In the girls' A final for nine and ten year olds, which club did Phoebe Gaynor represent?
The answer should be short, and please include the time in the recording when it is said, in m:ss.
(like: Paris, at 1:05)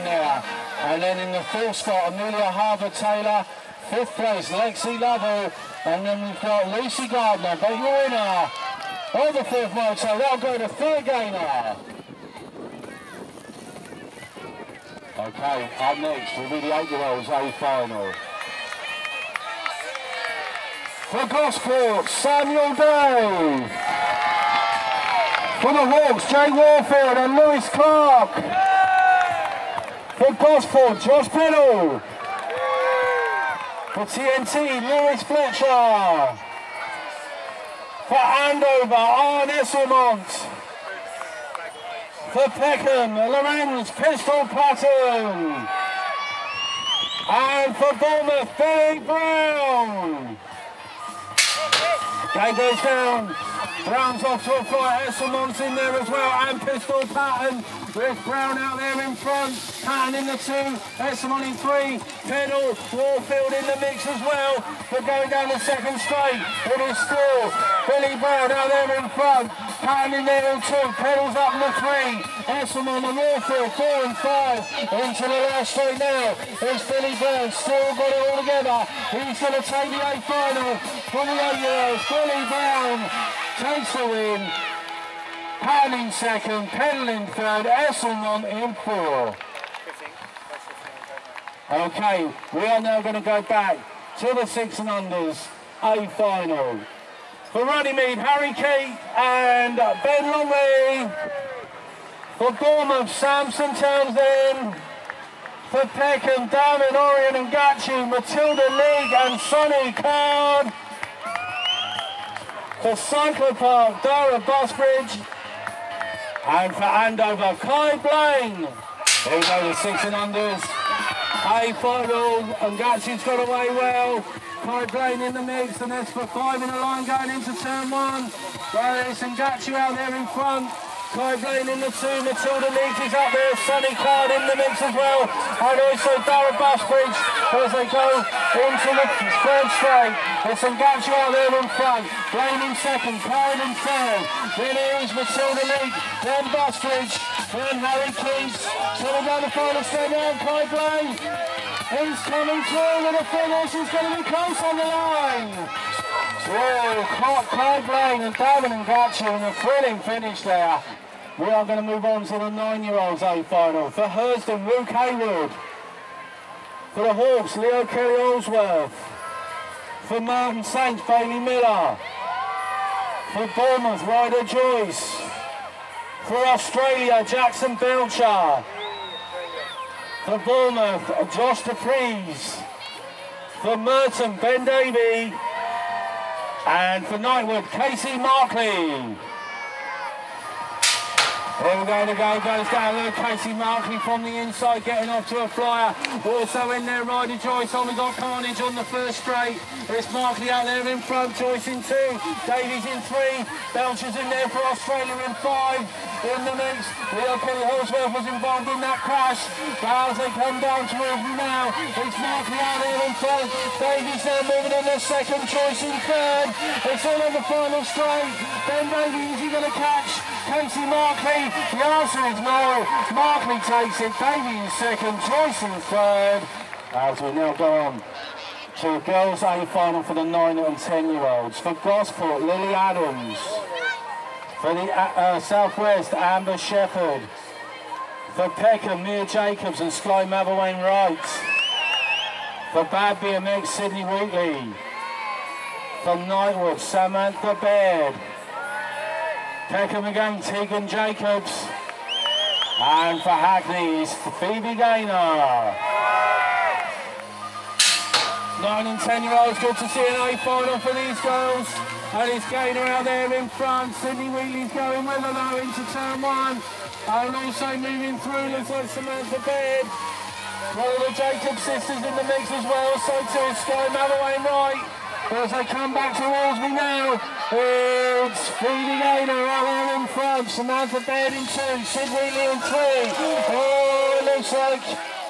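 Hackney, at 4:13.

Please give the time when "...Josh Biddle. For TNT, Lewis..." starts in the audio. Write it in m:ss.
0:31.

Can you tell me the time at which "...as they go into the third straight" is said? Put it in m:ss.
2:17.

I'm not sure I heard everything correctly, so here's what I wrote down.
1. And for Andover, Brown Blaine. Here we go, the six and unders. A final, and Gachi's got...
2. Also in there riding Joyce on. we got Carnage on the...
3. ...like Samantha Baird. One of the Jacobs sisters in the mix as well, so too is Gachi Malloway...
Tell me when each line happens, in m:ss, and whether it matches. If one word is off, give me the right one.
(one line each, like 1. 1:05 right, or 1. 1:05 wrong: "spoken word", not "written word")
1. 1:56 wrong: "Kai", not "Brown"
2. 3:16 right
3. 4:28 wrong: "Sky", not "Gachi".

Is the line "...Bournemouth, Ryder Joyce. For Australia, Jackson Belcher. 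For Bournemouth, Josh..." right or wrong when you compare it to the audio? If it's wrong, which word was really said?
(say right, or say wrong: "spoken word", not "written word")
right.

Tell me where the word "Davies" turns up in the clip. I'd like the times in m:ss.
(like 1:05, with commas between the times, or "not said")
3:22, 3:33, 3:38.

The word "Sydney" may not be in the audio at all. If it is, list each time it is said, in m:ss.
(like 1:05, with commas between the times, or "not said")
4:03, 4:24.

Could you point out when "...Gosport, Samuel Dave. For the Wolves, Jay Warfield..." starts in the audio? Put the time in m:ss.
0:21.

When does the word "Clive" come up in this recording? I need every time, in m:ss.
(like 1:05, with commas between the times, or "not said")
2:11, 2:30.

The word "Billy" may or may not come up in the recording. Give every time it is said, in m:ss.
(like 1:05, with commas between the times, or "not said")
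0:48, 1:07, 1:16, 1:22.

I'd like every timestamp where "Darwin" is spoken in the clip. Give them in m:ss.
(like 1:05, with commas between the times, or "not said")
1:46, 2:38.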